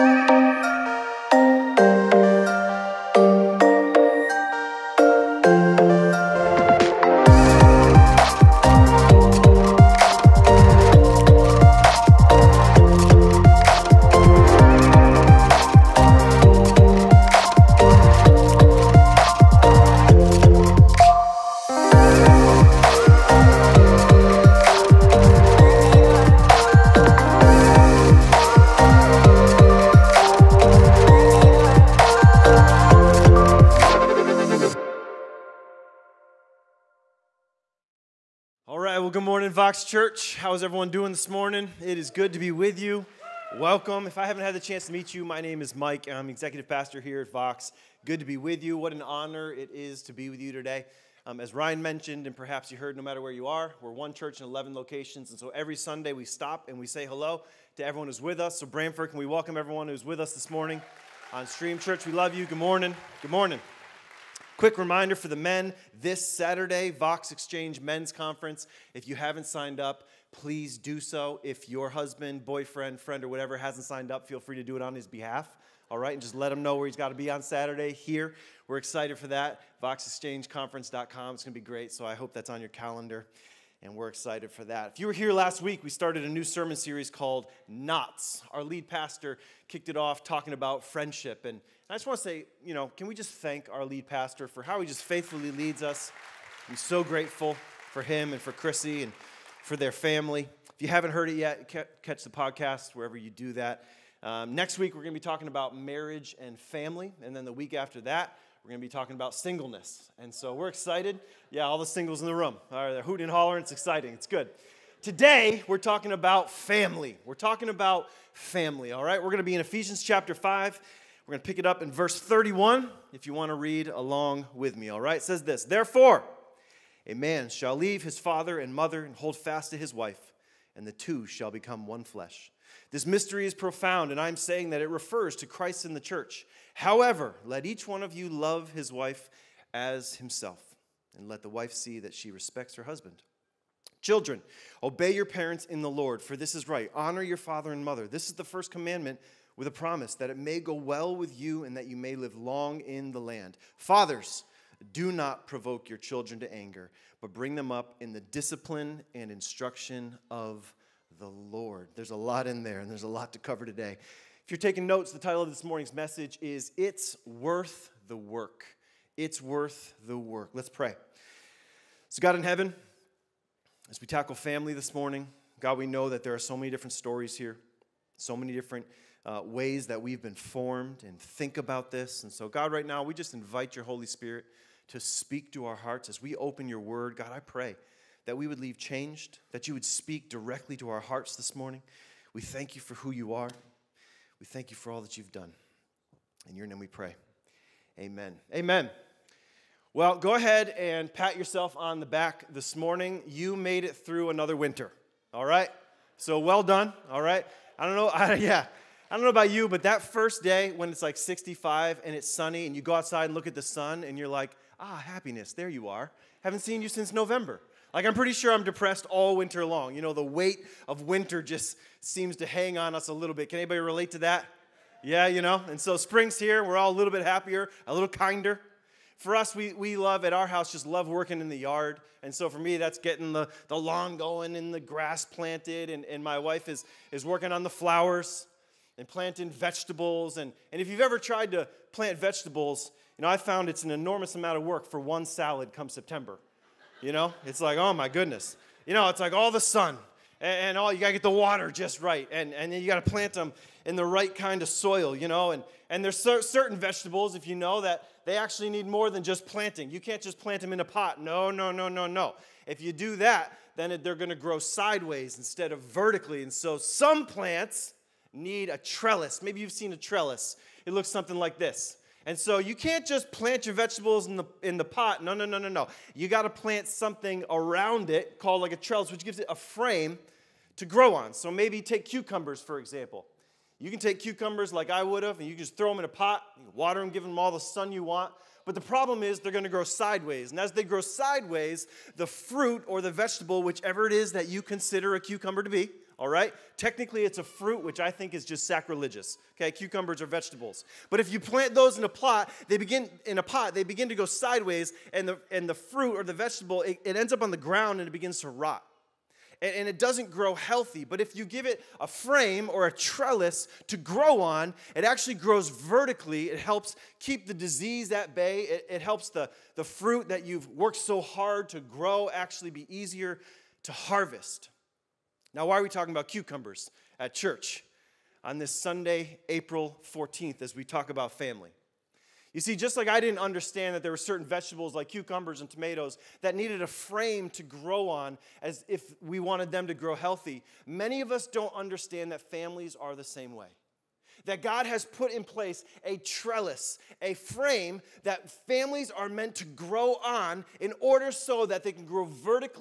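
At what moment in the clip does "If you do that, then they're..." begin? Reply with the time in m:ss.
4:22.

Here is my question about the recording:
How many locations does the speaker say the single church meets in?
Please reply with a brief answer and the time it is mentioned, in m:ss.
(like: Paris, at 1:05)
11, at 0:54.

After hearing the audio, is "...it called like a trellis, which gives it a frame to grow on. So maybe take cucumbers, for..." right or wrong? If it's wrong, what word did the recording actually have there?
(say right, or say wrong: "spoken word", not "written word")
right.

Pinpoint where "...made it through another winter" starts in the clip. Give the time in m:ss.
3:23.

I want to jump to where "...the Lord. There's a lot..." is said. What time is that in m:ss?
2:41.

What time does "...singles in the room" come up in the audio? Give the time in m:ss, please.
1:51.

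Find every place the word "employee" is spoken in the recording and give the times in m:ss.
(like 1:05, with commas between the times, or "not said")
not said.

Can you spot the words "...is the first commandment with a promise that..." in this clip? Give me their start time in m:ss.
2:28.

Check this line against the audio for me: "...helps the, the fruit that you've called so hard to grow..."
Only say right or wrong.
wrong.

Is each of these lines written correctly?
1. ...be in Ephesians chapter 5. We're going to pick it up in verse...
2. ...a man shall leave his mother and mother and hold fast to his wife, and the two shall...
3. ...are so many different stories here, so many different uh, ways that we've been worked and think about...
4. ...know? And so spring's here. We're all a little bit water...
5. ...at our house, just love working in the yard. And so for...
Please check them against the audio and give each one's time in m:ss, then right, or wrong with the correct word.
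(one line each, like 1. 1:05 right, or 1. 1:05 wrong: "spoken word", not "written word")
1. 1:59 right
2. 2:07 wrong: "father", not "mother"
3. 2:56 wrong: "formed", not "worked"
4. 3:45 wrong: "happier", not "water"
5. 3:50 right.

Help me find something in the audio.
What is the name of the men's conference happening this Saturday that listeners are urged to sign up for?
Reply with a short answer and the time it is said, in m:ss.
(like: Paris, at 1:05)
Vox Exchange Men's Conference, at 1:06.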